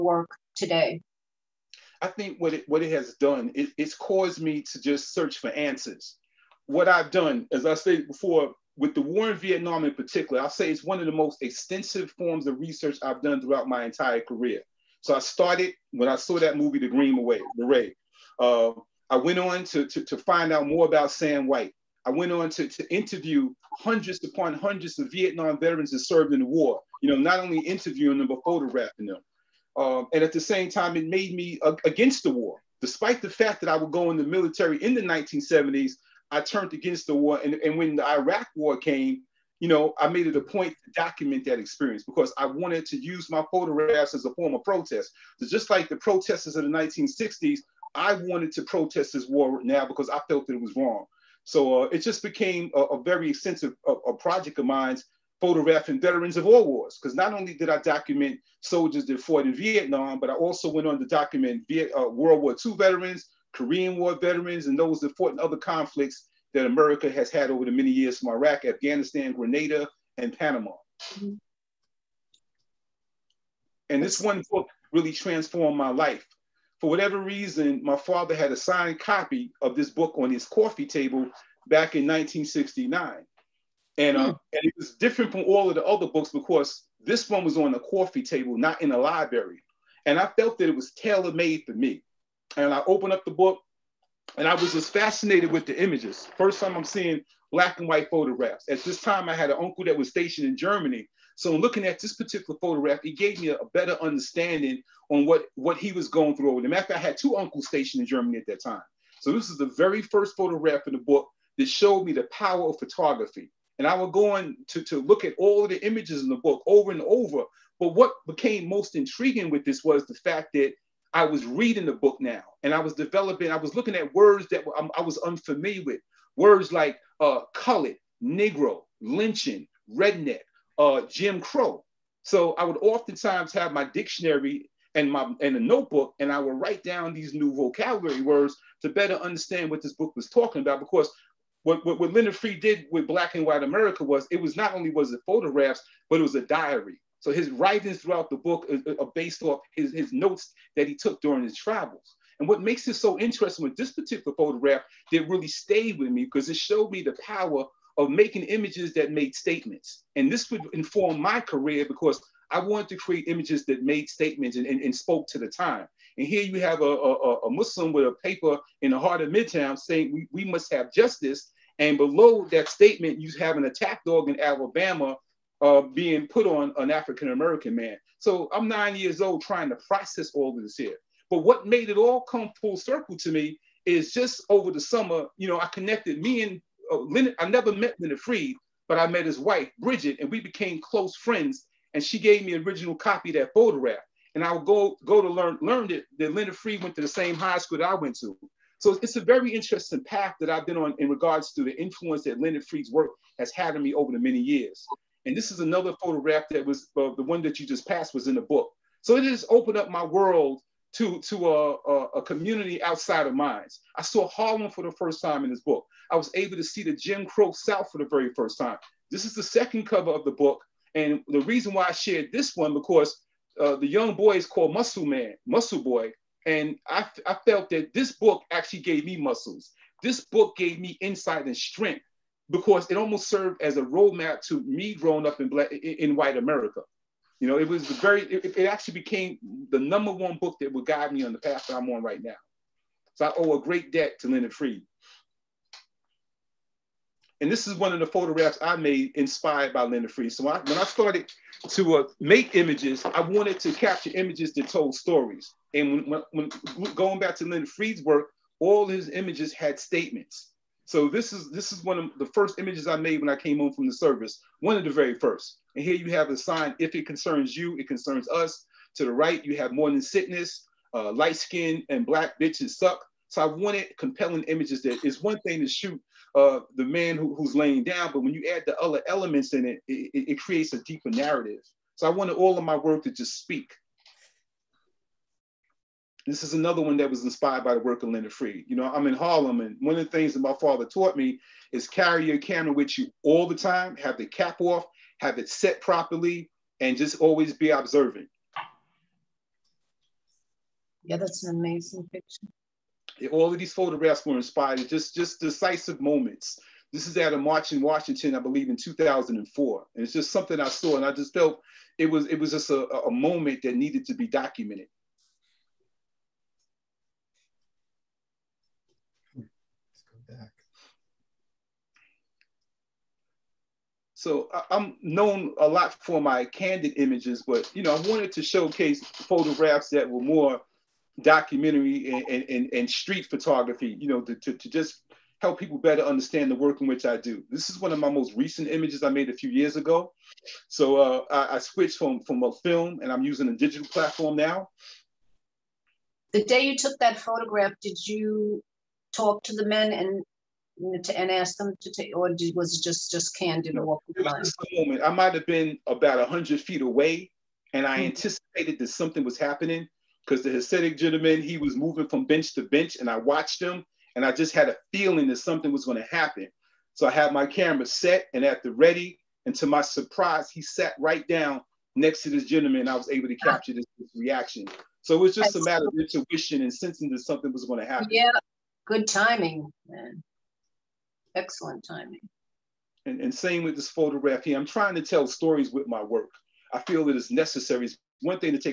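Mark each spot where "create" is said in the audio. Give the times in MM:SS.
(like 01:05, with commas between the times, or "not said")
02:42, 04:40.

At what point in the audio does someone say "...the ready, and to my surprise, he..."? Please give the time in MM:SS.
06:08.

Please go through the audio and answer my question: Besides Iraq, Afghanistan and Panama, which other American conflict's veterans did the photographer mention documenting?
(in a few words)
Grenada.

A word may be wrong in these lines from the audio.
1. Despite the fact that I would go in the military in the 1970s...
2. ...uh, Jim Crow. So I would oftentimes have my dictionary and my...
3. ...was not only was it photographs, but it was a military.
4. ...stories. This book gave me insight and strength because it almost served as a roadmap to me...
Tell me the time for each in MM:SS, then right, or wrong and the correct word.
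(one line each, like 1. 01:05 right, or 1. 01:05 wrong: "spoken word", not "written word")
1. 00:32 right
2. 02:10 right
3. 02:24 wrong: "diary", not "military"
4. 03:49 wrong: "muscles", not "stories".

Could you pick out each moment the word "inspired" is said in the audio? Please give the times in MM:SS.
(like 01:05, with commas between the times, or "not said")
04:09, 04:47, 05:04.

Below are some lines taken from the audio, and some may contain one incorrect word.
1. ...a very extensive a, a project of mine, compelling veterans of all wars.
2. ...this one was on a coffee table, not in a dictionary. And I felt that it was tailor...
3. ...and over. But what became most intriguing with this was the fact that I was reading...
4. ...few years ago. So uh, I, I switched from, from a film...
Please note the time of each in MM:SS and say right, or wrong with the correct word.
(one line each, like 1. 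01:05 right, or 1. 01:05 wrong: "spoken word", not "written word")
1. 00:52 wrong: "photographing", not "compelling"
2. 01:27 wrong: "library", not "dictionary"
3. 01:56 right
4. 05:39 right.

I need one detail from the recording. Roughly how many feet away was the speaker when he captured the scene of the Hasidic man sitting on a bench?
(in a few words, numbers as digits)
100.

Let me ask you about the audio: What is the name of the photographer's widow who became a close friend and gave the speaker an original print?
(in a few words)
Bridget.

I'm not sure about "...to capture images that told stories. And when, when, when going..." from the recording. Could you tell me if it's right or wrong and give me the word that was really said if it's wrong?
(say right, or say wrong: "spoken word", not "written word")
right.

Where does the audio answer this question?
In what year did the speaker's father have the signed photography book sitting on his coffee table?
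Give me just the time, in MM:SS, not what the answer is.
01:22.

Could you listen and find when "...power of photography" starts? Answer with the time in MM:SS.
01:52.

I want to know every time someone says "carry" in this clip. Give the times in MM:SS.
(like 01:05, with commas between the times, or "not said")
04:51.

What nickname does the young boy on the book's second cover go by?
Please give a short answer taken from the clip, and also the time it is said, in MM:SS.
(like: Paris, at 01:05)
Muscle Man, at 03:44.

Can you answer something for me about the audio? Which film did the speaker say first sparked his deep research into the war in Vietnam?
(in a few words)
The Green Beret.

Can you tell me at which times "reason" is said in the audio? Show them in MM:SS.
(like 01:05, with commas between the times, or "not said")
01:17, 03:41.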